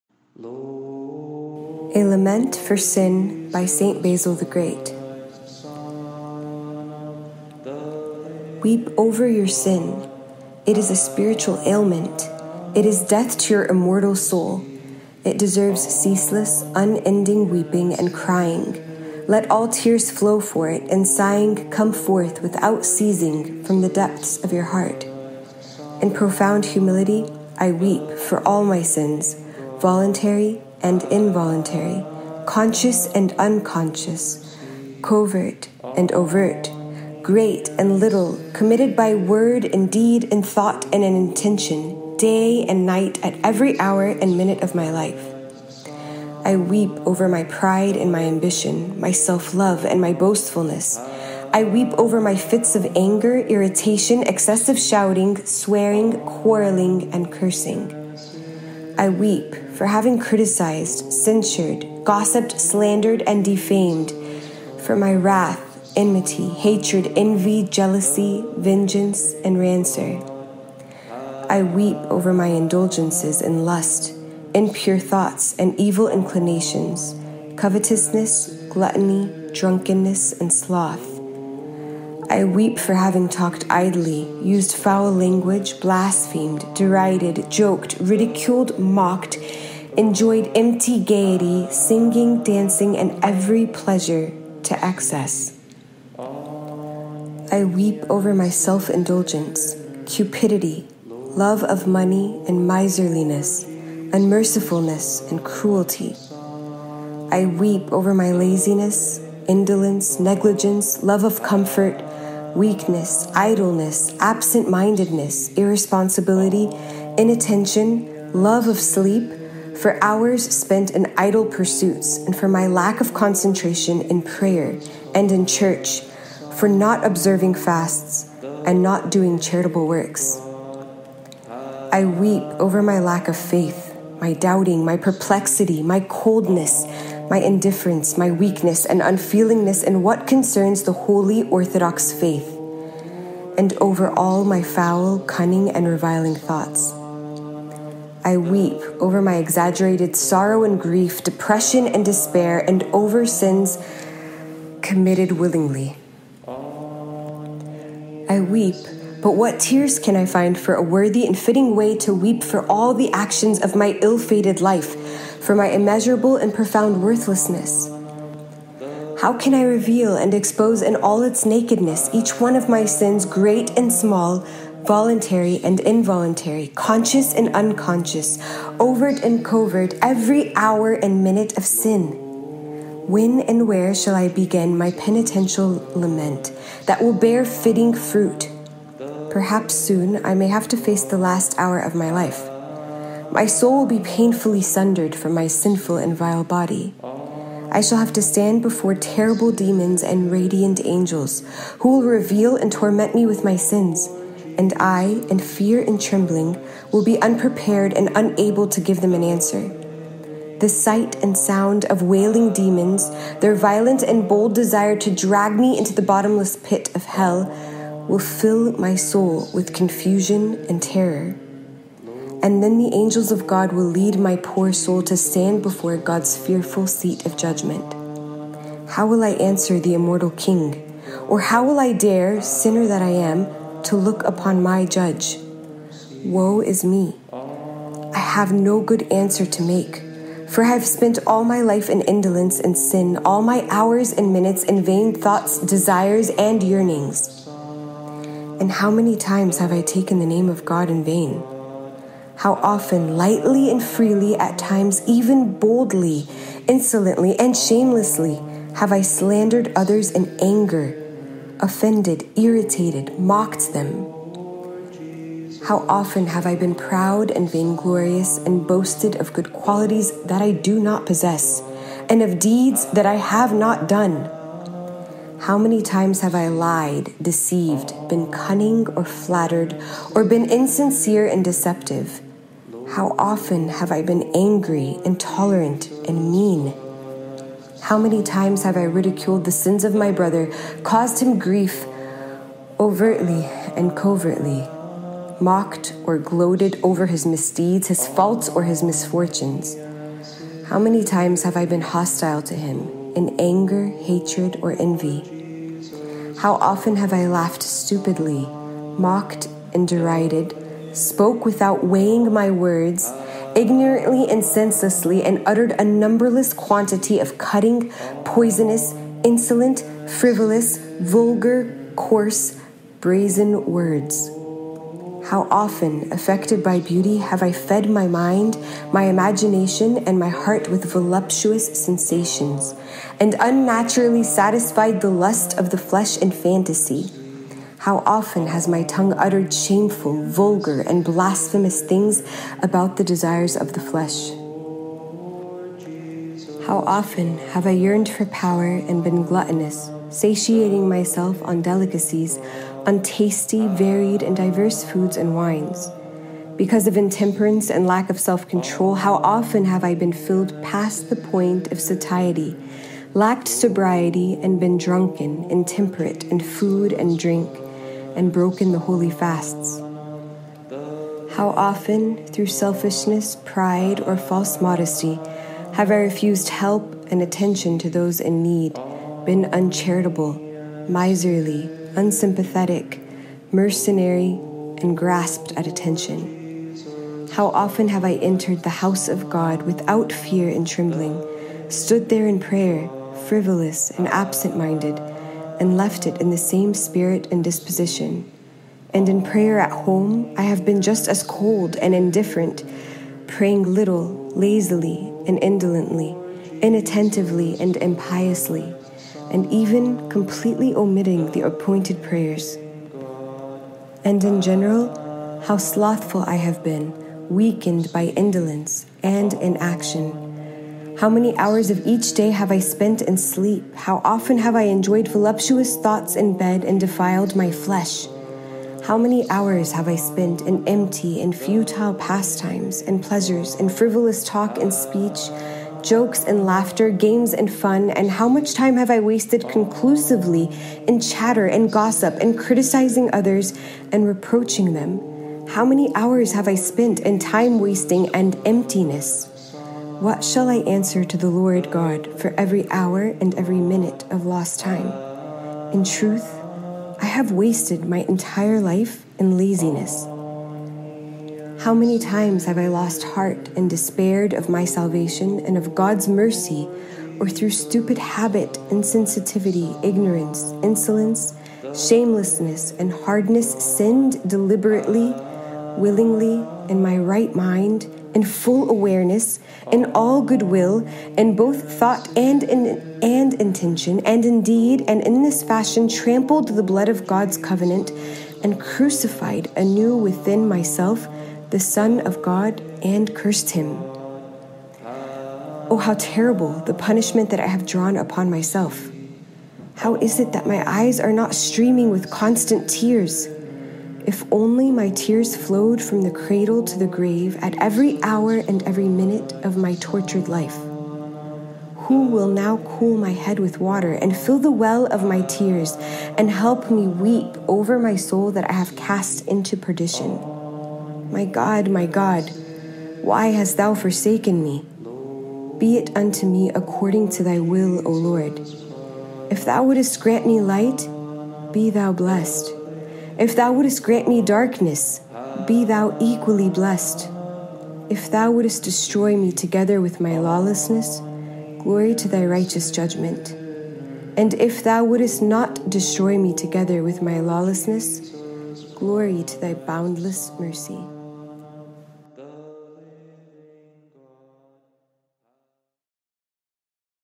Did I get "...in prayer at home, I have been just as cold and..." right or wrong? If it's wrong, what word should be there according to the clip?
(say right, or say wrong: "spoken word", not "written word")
right.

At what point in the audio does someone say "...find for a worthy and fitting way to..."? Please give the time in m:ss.
2:40.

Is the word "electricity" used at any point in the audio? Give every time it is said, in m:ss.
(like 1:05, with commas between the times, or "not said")
not said.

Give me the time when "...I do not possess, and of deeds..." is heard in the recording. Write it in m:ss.
4:30.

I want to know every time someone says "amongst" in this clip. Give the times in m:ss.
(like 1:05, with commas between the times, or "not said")
not said.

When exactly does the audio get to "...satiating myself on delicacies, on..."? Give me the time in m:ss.
5:50.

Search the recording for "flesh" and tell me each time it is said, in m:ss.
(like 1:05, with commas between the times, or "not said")
5:35, 5:43, 7:07.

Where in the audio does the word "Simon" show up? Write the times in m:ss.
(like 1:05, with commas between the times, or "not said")
not said.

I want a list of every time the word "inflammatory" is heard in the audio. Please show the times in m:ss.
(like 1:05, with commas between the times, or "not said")
not said.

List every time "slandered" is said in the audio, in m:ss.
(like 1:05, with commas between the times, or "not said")
1:02, 4:19.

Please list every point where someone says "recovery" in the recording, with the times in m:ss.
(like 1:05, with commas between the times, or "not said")
not said.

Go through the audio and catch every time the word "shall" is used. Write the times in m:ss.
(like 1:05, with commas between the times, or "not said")
3:03, 3:17, 7:30.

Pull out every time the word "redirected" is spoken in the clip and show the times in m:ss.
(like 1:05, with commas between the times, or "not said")
not said.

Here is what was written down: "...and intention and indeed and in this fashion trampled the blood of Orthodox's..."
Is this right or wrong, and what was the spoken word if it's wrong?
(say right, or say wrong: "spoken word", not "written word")
wrong: "God", not "Orthodox".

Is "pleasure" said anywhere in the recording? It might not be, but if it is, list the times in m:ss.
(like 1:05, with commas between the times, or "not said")
1:33, 7:13.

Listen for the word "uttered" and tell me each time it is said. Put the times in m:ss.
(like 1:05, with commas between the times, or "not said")
5:15, 5:39.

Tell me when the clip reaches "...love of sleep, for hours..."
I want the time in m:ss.
1:58.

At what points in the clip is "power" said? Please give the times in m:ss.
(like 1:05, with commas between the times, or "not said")
5:48.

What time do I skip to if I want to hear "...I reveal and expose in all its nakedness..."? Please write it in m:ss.
2:49.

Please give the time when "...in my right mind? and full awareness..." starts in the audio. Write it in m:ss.
7:56.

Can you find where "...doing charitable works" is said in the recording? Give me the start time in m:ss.
2:09.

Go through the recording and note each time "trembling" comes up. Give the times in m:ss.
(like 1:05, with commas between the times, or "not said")
3:25, 6:30.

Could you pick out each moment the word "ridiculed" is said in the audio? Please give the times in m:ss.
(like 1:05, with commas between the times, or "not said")
1:27, 4:48.